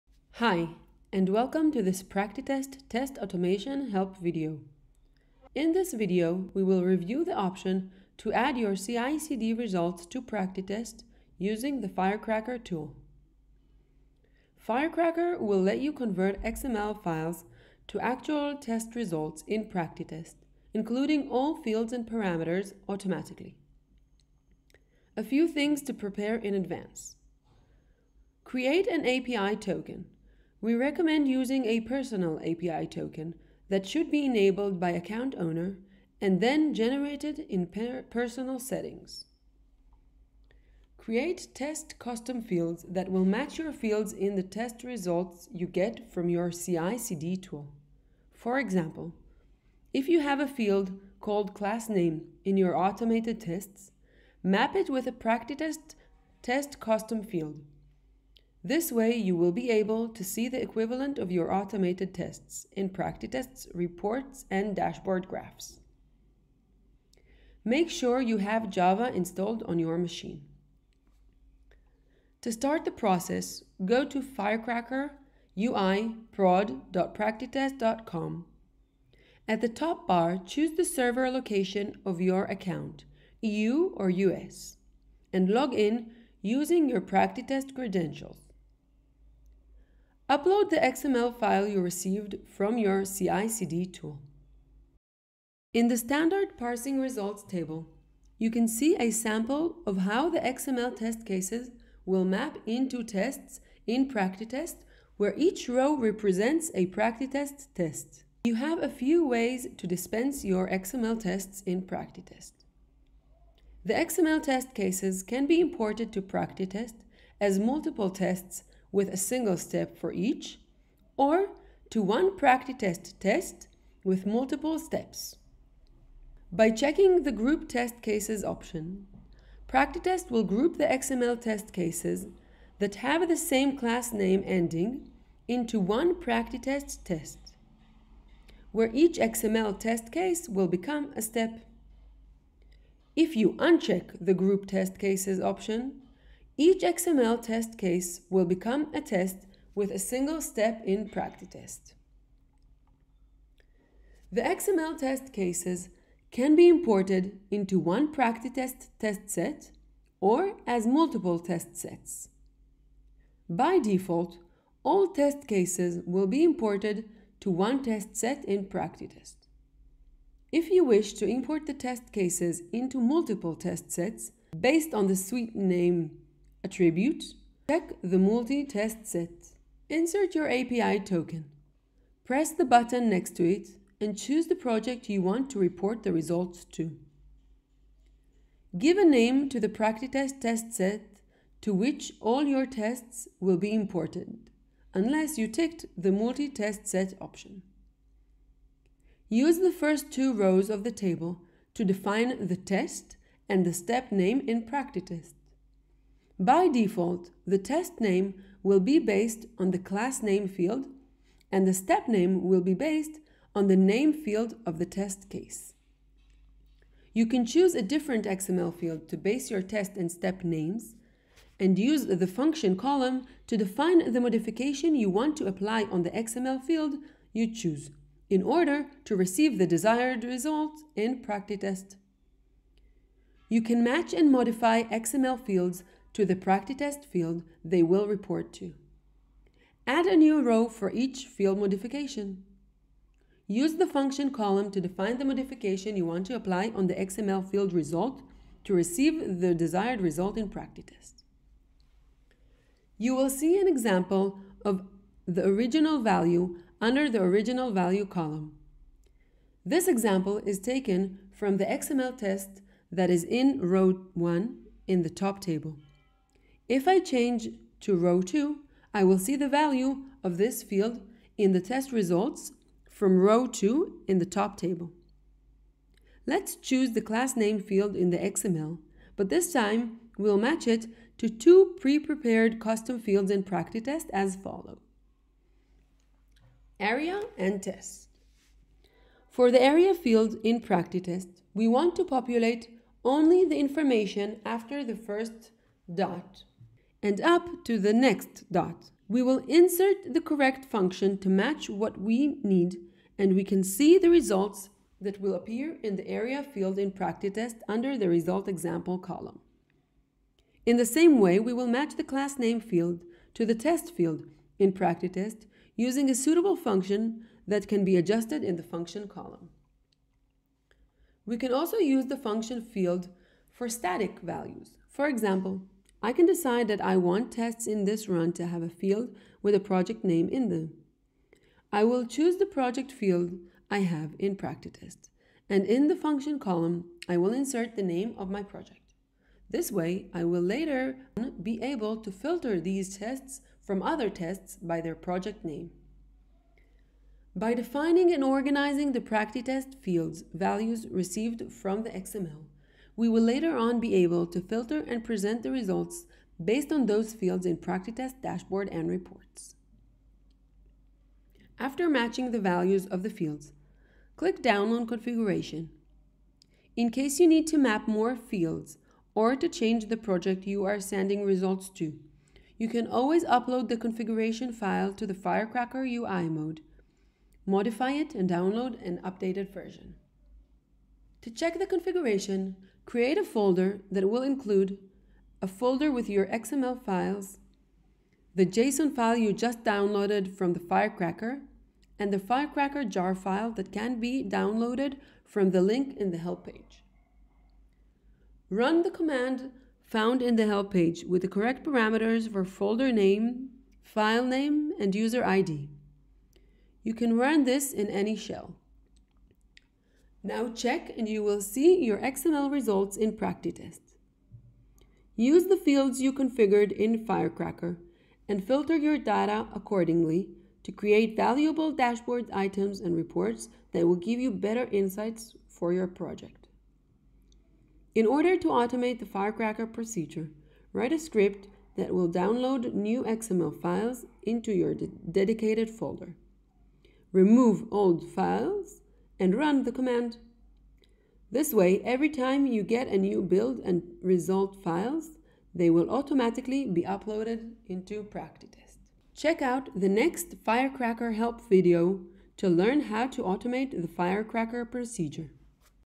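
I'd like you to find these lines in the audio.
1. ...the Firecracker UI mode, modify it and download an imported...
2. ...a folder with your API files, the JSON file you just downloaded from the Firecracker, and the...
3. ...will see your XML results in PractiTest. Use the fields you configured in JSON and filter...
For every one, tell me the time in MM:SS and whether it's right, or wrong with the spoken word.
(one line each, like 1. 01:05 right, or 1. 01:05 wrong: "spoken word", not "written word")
1. 06:15 wrong: "updated", not "imported"
2. 06:25 wrong: "XML", not "API"
3. 06:51 wrong: "Firecracker", not "JSON".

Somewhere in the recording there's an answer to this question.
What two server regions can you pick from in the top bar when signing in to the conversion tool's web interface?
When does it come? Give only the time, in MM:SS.
01:23.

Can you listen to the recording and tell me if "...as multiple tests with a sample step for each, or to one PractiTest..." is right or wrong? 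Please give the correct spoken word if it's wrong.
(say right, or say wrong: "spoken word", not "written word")
wrong: "single", not "sample".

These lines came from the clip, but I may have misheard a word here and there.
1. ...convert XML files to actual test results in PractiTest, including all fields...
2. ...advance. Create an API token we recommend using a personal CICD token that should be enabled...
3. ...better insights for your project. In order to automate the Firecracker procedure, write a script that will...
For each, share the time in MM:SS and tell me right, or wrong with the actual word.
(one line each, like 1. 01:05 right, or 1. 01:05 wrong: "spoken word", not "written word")
1. 00:15 right
2. 00:26 wrong: "API", not "CICD"
3. 07:04 right.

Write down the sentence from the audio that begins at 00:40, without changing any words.
Create test custom fields that will match your fields in the test results you get from your CI/CD tool.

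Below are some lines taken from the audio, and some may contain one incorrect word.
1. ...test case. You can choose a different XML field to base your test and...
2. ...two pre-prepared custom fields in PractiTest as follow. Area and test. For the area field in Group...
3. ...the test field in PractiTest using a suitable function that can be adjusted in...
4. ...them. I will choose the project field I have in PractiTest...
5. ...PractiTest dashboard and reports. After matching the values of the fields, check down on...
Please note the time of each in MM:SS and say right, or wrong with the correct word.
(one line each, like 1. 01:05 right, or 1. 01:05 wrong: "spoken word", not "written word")
1. 03:34 right
2. 04:41 wrong: "PractiTest", not "Group"
3. 05:13 right
4. 05:30 right
5. 05:57 wrong: "click", not "check".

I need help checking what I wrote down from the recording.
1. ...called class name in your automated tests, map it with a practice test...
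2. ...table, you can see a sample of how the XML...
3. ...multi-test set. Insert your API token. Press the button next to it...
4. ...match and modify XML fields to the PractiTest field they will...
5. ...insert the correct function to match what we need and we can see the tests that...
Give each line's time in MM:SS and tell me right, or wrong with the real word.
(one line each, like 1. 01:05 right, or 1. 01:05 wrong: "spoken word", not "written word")
1. 00:51 right
2. 01:37 right
3. 02:58 right
4. 03:53 right
5. 04:59 wrong: "results", not "tests".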